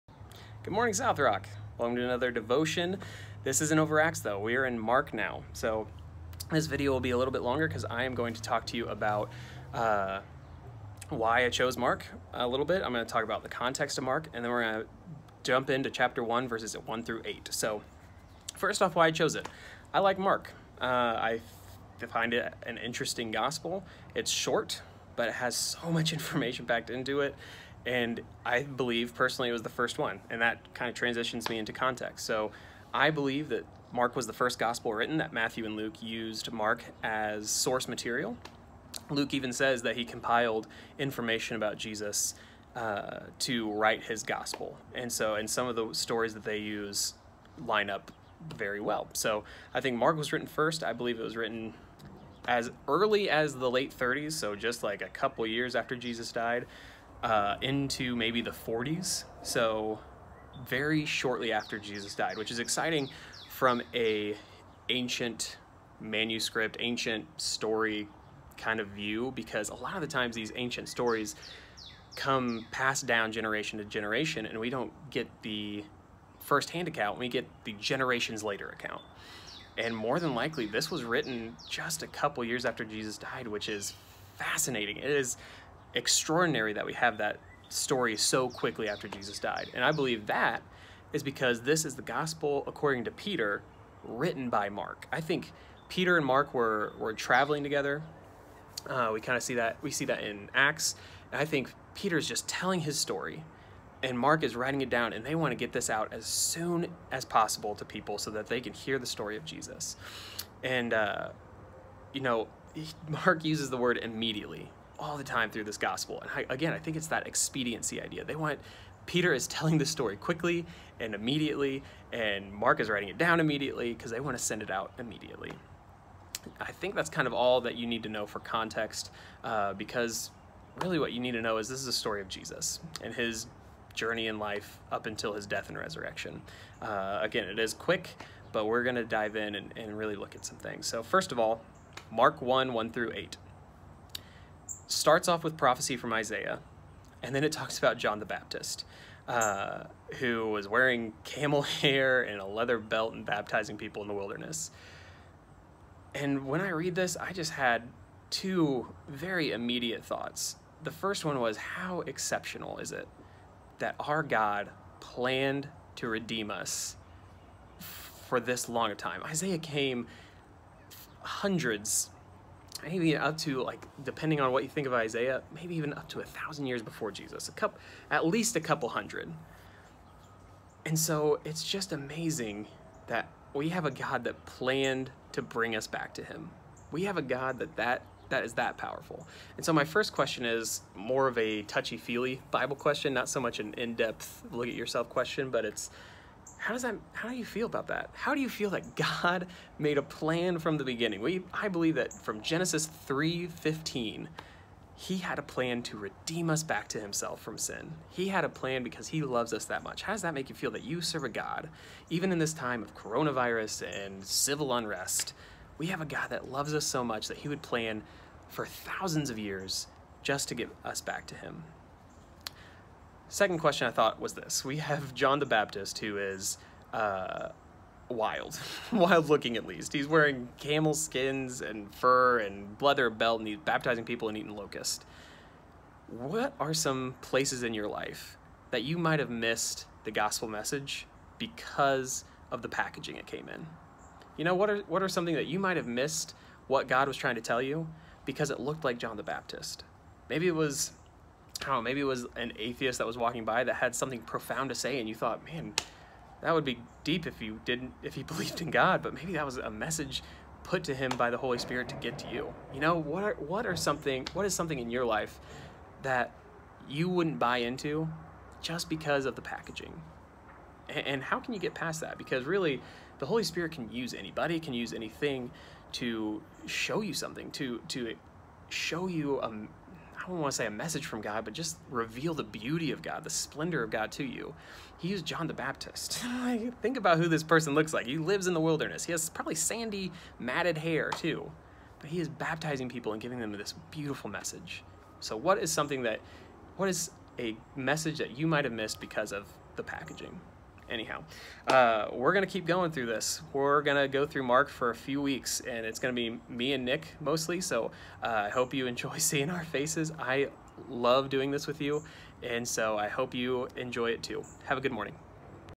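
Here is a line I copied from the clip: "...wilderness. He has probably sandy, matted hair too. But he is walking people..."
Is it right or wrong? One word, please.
wrong.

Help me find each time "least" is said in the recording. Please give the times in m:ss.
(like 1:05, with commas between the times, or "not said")
2:58, 3:49.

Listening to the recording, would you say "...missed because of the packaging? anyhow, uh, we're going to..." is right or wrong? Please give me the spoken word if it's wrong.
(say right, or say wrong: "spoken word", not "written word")
right.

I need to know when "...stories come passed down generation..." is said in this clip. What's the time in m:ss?
1:10.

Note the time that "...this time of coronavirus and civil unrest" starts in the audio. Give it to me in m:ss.
3:32.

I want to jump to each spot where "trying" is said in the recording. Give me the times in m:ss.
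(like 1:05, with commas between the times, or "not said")
4:07.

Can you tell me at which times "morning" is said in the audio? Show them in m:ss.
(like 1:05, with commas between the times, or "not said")
0:00, 5:14.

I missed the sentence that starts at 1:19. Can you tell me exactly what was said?
And more than likely, this was written just a couple years after Jesus died, which is fascinating.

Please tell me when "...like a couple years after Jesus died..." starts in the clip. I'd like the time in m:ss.
0:54.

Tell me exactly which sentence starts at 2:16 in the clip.
Uh, again, it is quick, but we're going to dive in and, and really look at some things.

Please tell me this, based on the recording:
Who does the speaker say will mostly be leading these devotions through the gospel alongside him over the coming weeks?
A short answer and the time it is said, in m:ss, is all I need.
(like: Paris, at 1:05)
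Nick, at 5:06.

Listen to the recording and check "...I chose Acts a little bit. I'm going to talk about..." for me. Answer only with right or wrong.
wrong.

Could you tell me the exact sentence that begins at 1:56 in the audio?
And I, again, I think it's that expediency idea.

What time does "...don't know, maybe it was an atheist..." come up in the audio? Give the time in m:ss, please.
4:11.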